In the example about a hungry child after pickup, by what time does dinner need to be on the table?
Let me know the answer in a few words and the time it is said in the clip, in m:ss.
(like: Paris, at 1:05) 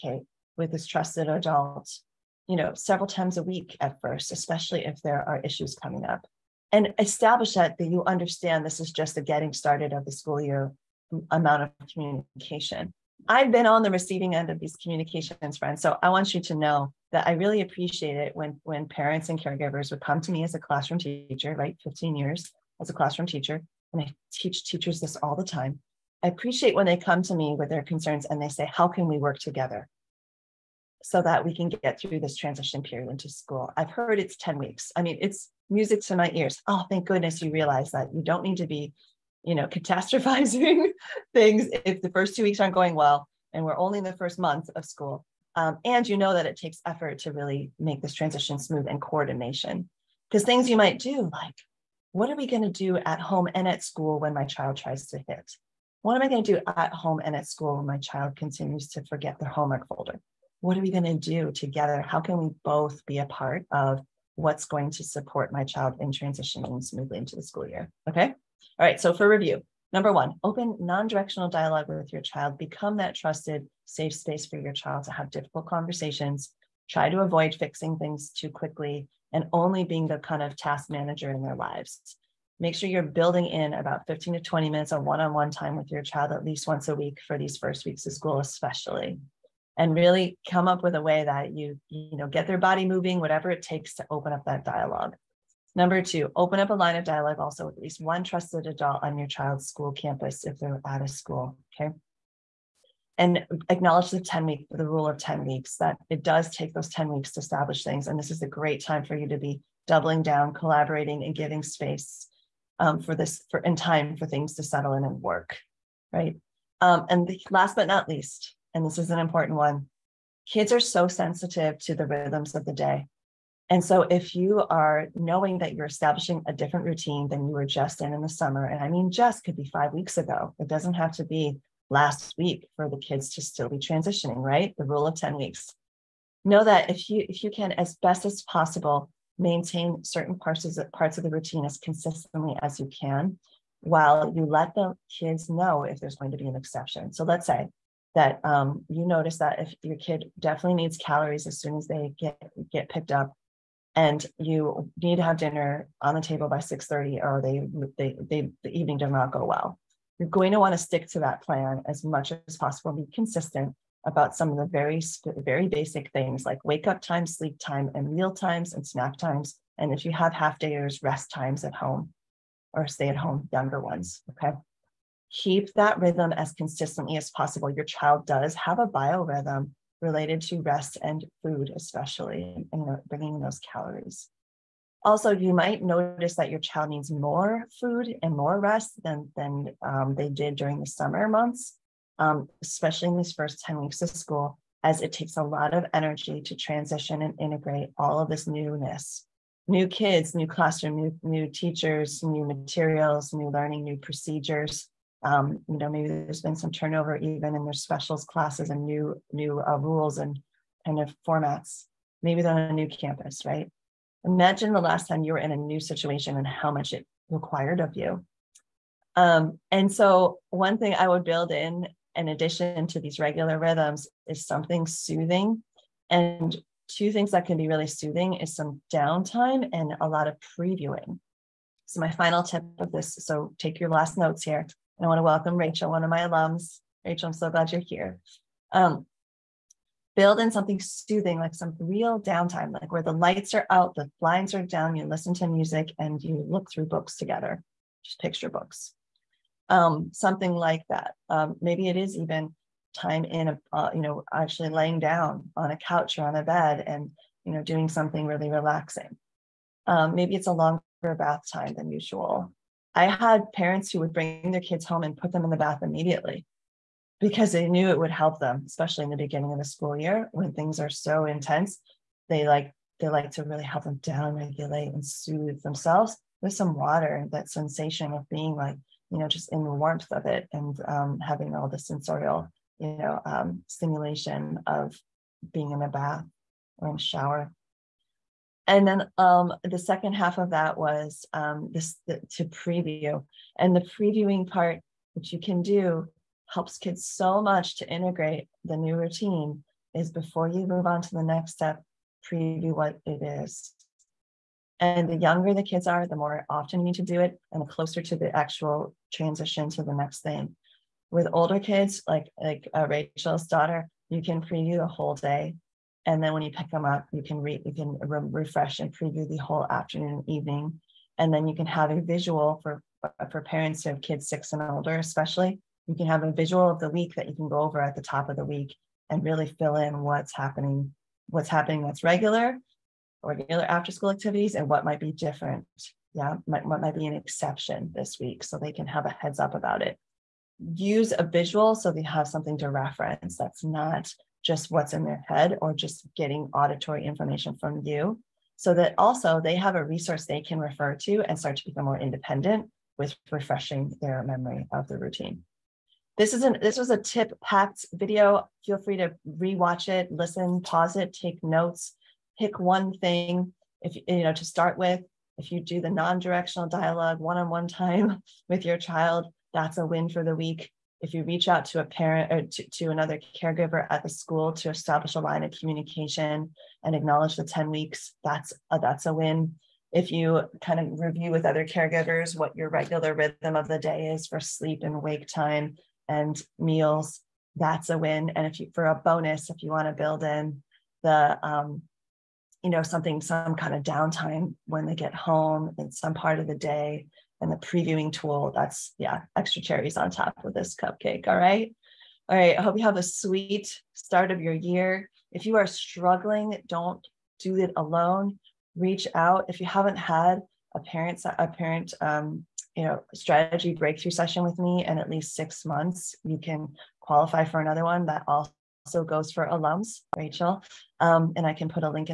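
6:30, at 2:36.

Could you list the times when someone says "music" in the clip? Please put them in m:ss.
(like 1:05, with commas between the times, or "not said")
0:35, 4:05.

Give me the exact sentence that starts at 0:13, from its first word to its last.
I've been on the receiving end of these communications, friends.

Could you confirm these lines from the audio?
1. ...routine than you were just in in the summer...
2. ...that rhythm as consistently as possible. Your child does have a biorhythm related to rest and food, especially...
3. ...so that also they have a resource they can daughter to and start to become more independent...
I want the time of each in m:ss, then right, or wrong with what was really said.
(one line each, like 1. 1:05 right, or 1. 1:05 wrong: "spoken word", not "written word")
1. 2:06 right
2. 2:55 right
3. 5:48 wrong: "refer", not "daughter".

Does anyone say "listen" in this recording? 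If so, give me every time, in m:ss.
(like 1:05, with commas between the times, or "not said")
4:05, 6:00.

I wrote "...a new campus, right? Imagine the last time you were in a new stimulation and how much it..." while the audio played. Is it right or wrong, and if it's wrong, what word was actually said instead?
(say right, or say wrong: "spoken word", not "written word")
wrong: "situation", not "stimulation".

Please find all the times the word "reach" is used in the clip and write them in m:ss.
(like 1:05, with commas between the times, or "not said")
6:11, 6:48.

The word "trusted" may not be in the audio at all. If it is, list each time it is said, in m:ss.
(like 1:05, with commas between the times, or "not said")
0:00, 1:13, 1:38.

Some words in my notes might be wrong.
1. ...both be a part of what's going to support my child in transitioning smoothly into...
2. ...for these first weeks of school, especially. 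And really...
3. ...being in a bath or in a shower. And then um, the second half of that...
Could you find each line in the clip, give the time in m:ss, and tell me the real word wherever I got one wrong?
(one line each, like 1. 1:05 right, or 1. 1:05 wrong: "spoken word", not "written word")
1. 1:02 right
2. 1:27 right
3. 4:45 right.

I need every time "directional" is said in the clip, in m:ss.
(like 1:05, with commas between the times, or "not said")
1:11, 6:05.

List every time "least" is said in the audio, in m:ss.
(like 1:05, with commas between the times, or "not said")
1:26, 1:37, 1:58, 6:55.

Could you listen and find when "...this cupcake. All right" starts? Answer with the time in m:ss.
6:40.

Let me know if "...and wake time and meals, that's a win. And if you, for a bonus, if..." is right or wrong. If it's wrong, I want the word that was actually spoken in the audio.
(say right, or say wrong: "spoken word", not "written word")
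right.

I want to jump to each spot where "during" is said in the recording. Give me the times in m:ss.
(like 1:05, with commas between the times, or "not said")
3:10.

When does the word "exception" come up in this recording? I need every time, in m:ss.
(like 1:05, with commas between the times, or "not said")
2:26, 5:37.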